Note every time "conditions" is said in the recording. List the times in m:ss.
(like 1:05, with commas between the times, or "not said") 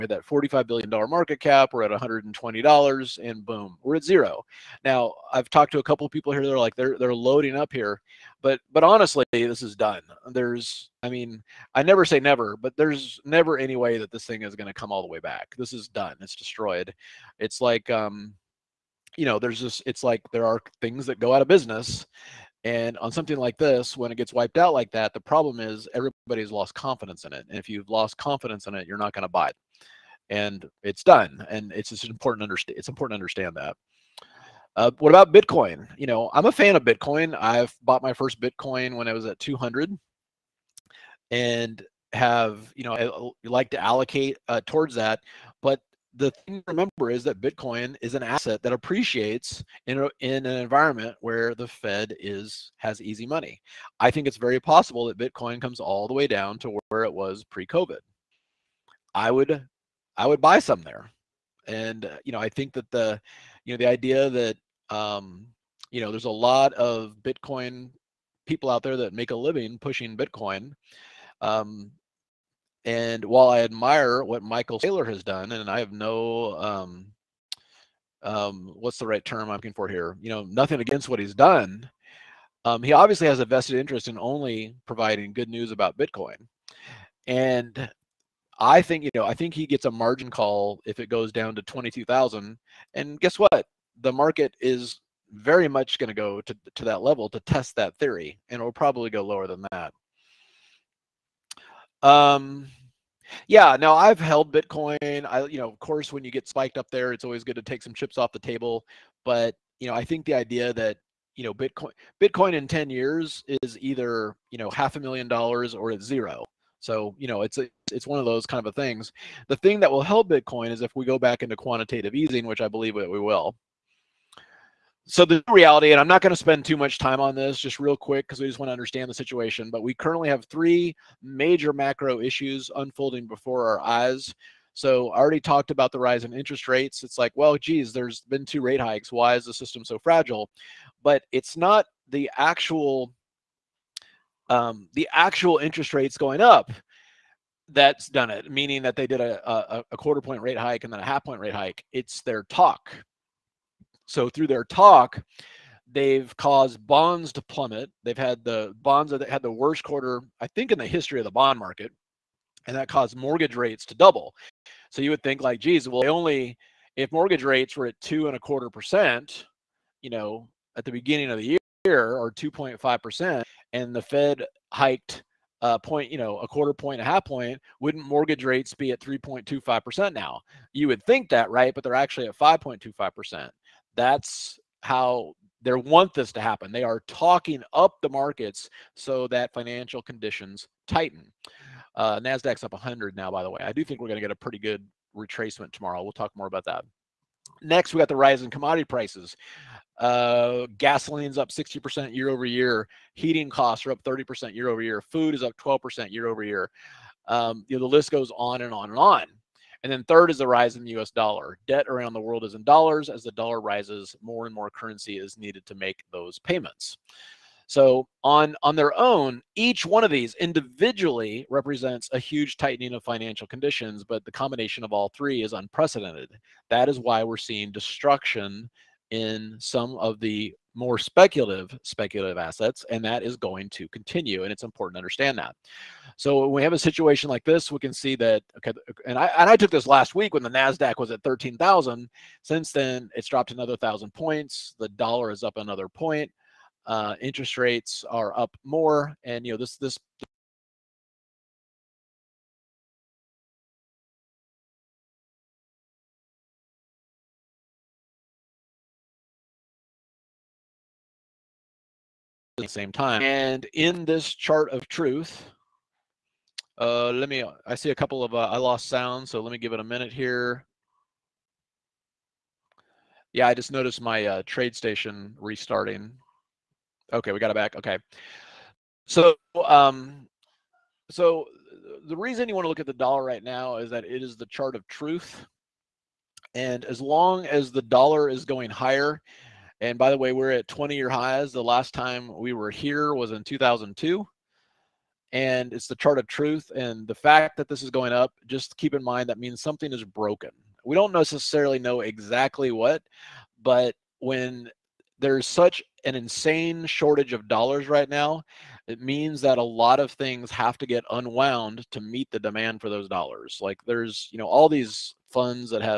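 3:10, 3:43.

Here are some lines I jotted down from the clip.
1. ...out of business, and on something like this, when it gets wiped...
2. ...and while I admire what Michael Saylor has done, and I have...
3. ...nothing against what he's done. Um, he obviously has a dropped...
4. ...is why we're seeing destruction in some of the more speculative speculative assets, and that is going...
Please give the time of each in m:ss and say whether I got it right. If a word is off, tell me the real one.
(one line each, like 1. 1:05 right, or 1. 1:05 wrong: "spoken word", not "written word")
1. 0:21 right
2. 1:12 right
3. 1:20 wrong: "vested", not "dropped"
4. 3:46 right.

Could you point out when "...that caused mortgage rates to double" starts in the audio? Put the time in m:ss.
2:42.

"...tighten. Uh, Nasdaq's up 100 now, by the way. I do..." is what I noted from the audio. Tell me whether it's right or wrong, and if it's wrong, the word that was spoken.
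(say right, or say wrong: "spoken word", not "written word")
right.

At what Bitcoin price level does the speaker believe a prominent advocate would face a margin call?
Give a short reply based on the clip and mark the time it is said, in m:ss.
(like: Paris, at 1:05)
22,000, at 1:31.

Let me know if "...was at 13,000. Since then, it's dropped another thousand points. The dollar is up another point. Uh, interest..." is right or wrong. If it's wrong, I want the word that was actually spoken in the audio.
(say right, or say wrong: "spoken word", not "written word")
right.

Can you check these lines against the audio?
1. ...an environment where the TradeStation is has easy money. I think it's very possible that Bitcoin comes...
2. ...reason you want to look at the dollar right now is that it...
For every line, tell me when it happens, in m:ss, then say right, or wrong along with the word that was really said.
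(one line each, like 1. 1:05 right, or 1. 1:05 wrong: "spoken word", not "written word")
1. 0:50 wrong: "Fed", not "TradeStation"
2. 4:42 right.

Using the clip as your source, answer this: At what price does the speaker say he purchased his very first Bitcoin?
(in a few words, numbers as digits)
200.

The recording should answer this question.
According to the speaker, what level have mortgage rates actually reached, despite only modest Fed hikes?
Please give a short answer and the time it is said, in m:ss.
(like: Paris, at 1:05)
5.25%, at 3:02.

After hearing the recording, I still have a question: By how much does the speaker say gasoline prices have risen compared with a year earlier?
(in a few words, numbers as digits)
60%.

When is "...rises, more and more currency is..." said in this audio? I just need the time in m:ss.
3:33.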